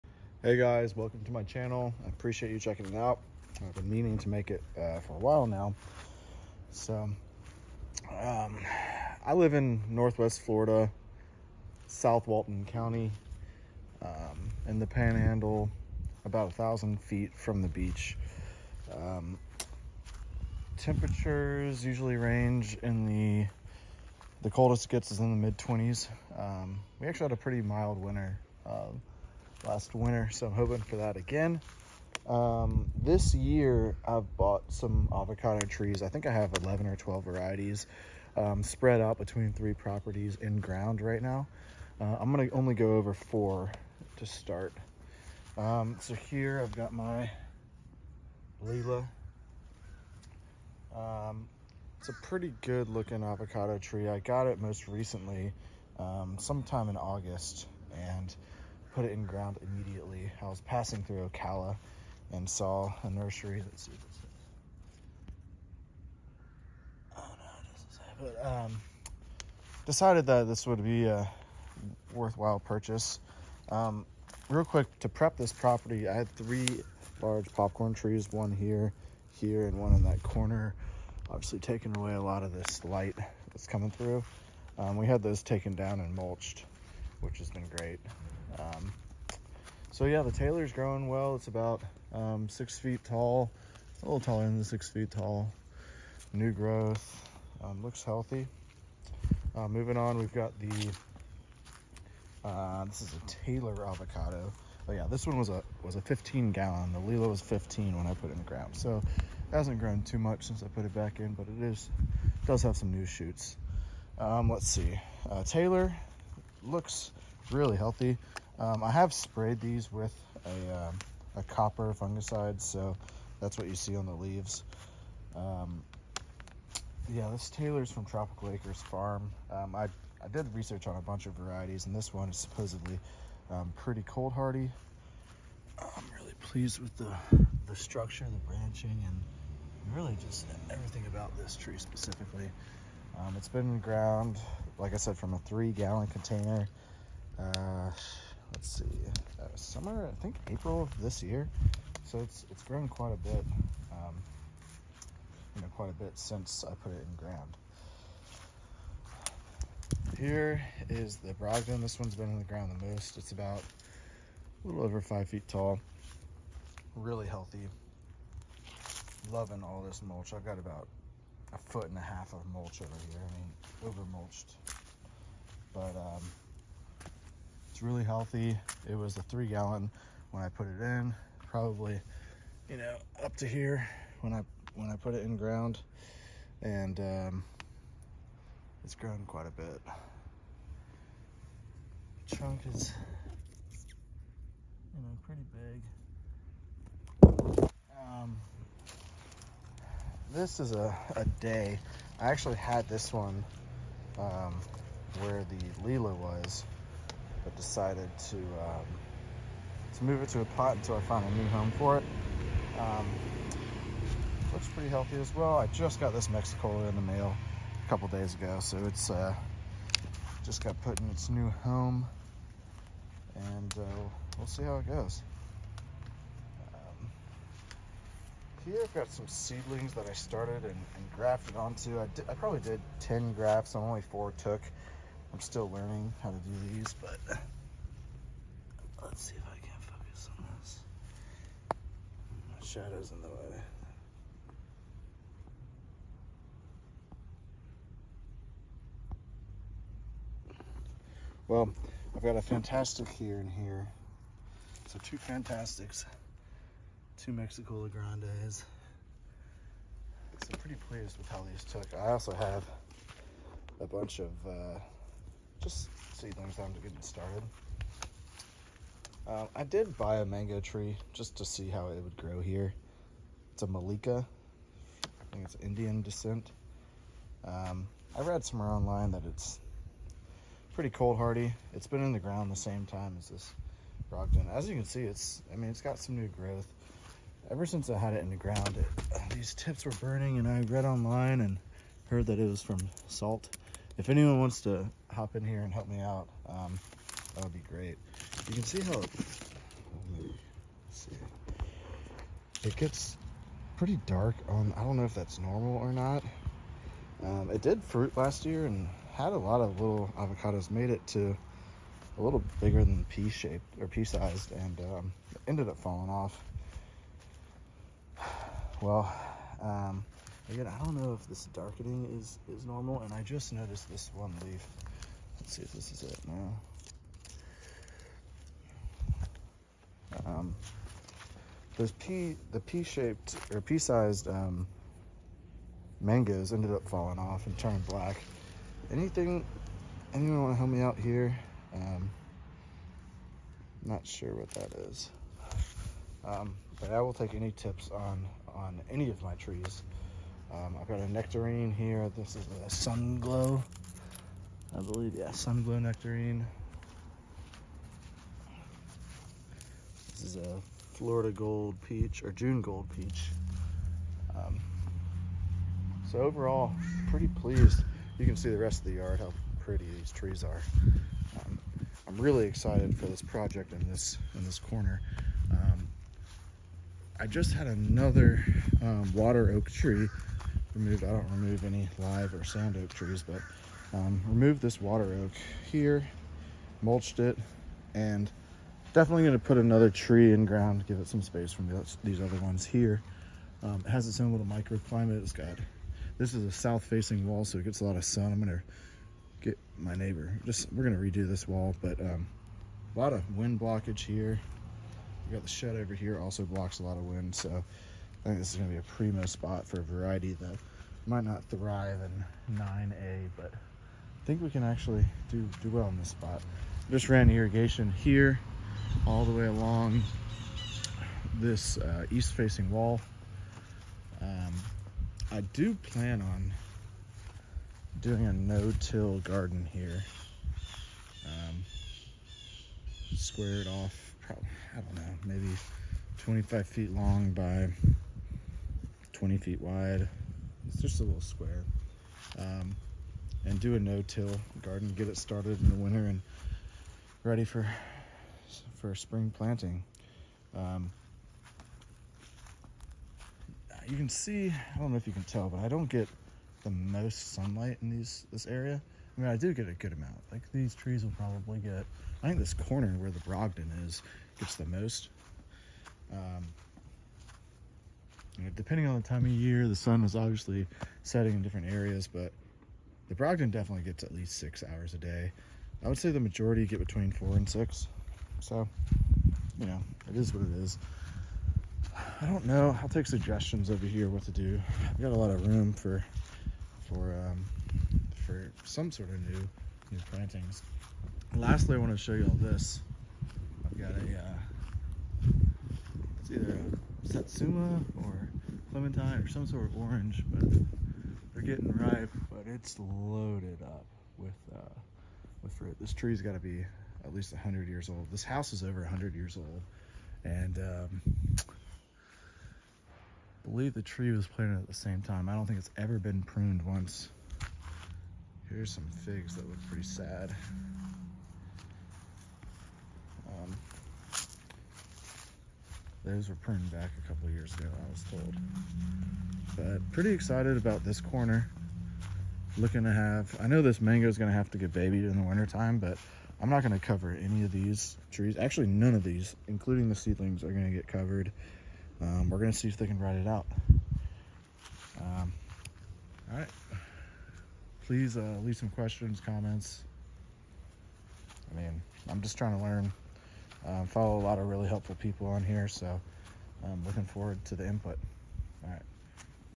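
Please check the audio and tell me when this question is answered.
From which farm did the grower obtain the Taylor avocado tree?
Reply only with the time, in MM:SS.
02:08.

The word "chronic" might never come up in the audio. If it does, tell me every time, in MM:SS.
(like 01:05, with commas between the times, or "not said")
not said.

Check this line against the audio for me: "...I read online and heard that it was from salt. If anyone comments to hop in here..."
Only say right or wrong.
wrong.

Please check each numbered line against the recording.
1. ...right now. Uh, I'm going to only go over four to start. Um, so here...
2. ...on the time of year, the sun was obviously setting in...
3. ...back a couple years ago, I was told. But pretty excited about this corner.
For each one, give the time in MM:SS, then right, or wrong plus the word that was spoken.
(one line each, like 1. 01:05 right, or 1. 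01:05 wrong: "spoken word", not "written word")
1. 00:41 right
2. 07:48 right
3. 08:46 right.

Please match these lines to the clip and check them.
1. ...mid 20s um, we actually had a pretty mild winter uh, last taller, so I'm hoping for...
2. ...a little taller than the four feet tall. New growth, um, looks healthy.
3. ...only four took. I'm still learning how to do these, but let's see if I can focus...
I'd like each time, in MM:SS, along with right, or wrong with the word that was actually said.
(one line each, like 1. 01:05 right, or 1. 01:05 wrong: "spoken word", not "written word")
1. 00:25 wrong: "winter", not "taller"
2. 01:34 wrong: "six", not "four"
3. 03:53 right.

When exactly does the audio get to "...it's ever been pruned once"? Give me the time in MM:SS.
08:35.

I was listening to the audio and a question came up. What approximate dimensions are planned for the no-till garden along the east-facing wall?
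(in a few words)
25 by 20 feet.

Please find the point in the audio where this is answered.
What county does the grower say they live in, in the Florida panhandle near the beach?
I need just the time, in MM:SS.
00:11.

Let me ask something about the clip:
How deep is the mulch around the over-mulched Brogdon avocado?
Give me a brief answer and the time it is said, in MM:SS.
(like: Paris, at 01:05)
A foot and a half, at 02:51.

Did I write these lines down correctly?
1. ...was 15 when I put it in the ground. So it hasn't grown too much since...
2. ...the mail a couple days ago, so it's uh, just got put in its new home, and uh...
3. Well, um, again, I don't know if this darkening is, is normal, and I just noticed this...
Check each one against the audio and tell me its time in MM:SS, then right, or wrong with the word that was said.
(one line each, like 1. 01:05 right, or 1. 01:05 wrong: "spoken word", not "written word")
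1. 01:47 right
2. 03:36 right
3. 05:18 right.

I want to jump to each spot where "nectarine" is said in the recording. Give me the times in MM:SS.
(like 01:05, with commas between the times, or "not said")
05:51, 05:55.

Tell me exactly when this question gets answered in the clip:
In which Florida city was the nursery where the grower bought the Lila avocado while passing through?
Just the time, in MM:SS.
01:01.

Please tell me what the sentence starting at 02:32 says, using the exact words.
So it's, it's grown quite a bit, um, you know, quite a bit since I put it in ground.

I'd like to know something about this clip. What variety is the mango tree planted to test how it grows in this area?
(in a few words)
Mallika.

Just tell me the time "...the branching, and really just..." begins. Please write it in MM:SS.
02:18.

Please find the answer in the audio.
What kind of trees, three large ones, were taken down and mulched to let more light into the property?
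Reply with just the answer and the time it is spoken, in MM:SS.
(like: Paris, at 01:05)
Popcorn trees, at 01:17.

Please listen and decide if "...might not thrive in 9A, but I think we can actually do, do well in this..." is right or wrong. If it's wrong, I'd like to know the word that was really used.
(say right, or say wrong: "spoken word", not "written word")
right.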